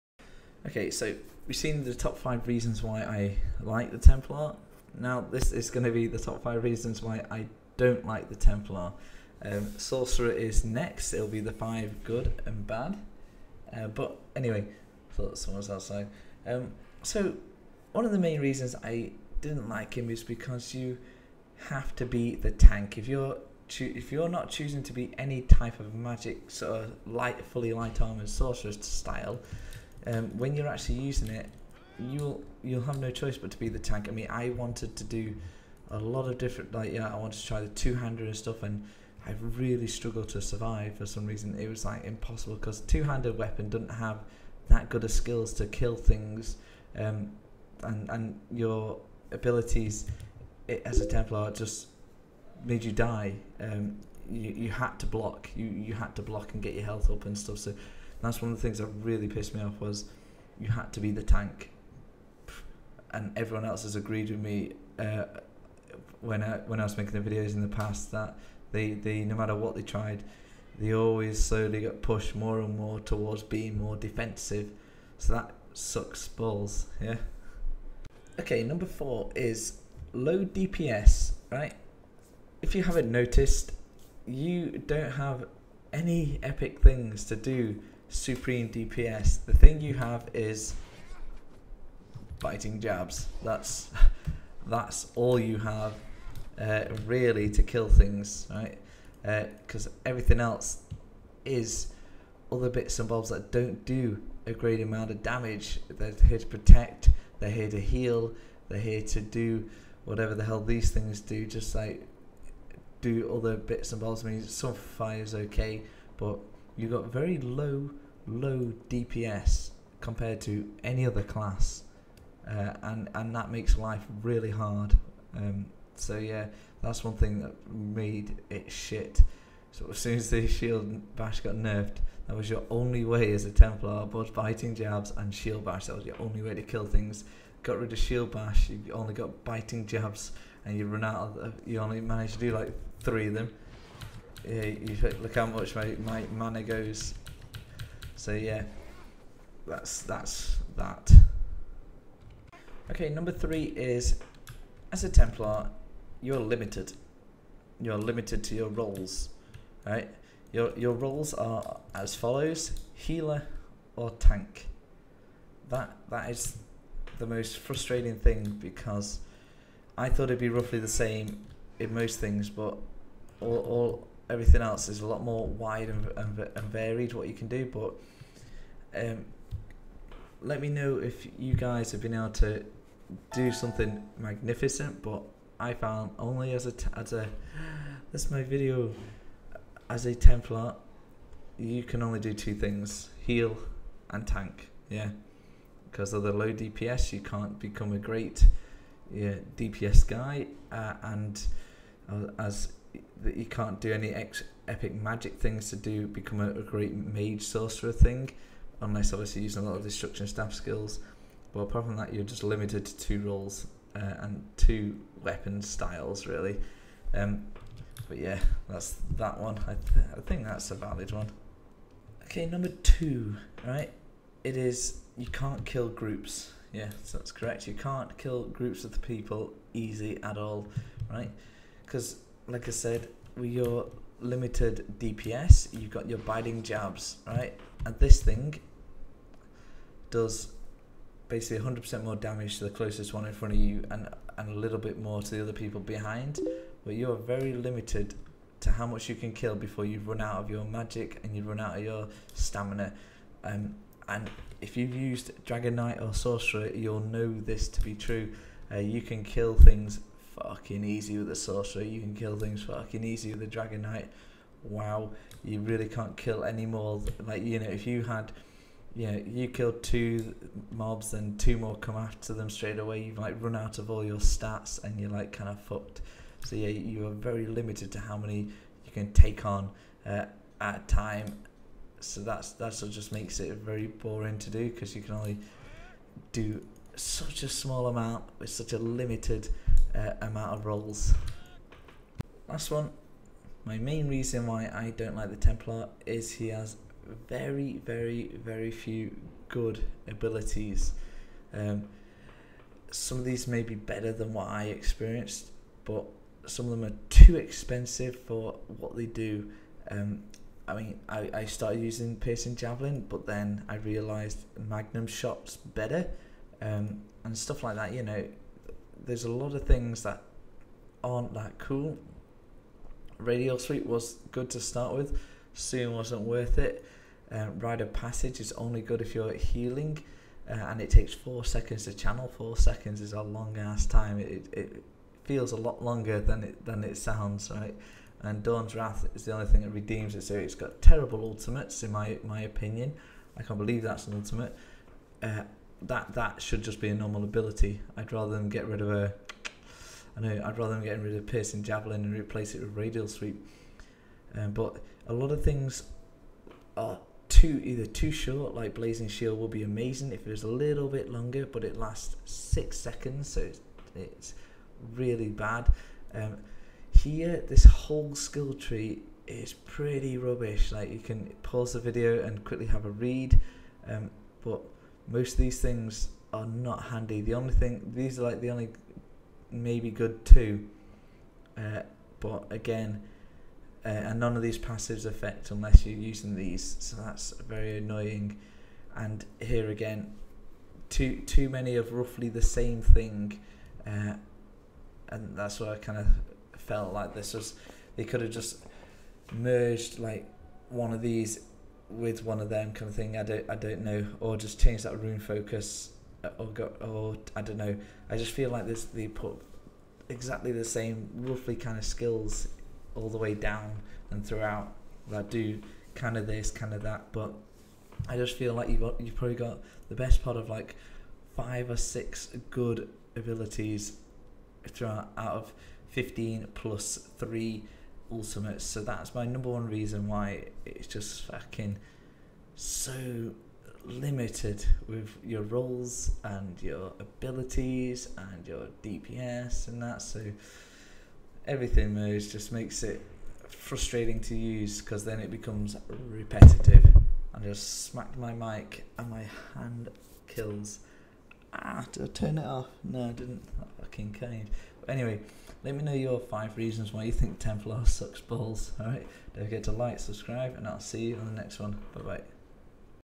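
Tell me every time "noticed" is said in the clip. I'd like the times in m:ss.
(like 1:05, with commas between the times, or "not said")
1:23.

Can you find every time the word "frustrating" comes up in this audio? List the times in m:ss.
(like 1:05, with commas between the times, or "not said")
2:47, 7:23.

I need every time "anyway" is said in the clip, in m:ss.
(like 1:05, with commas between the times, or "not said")
0:14, 7:34.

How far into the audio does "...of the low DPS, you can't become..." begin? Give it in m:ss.
3:16.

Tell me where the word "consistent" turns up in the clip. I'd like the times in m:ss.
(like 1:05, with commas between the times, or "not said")
not said.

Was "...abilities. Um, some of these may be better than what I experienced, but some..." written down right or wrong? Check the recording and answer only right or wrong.
right.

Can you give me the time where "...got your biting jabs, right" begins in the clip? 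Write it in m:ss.
3:55.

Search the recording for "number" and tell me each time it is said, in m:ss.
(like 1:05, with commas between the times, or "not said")
1:18, 2:33, 3:42, 7:09.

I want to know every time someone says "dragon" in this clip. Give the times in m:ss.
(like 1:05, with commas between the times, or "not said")
4:15, 4:23.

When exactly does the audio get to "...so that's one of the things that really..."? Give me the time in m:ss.
0:57.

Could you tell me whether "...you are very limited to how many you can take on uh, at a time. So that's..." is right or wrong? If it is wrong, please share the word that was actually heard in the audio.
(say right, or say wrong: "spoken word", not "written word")
right.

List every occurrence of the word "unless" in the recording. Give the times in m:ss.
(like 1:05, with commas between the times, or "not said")
3:28, 6:25.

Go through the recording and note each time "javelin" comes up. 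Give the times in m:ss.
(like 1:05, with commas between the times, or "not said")
5:12, 5:51.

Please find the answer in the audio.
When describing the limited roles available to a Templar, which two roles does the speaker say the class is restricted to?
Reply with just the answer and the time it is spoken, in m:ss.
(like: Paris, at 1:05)
healer or tank, at 2:42.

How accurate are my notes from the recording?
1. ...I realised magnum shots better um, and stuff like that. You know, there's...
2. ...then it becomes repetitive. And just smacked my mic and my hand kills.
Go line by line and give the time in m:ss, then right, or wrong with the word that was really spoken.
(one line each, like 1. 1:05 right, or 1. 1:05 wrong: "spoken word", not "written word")
1. 5:13 right
2. 7:25 right.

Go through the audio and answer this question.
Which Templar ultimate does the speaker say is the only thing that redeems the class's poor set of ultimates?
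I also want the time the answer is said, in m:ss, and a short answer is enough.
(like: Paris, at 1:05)
Dawn's Wrath, at 5:38.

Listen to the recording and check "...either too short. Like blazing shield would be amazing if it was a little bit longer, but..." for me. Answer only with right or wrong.
right.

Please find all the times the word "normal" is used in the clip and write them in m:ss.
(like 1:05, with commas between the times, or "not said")
5:46.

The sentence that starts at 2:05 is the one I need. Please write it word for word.
Um, so yeah, that's one thing that made it shit.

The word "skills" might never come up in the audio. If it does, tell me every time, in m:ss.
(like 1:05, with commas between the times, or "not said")
0:45, 3:30, 6:08, 6:51.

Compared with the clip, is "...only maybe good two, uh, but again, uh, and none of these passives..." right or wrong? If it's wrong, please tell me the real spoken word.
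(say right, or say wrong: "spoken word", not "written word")
right.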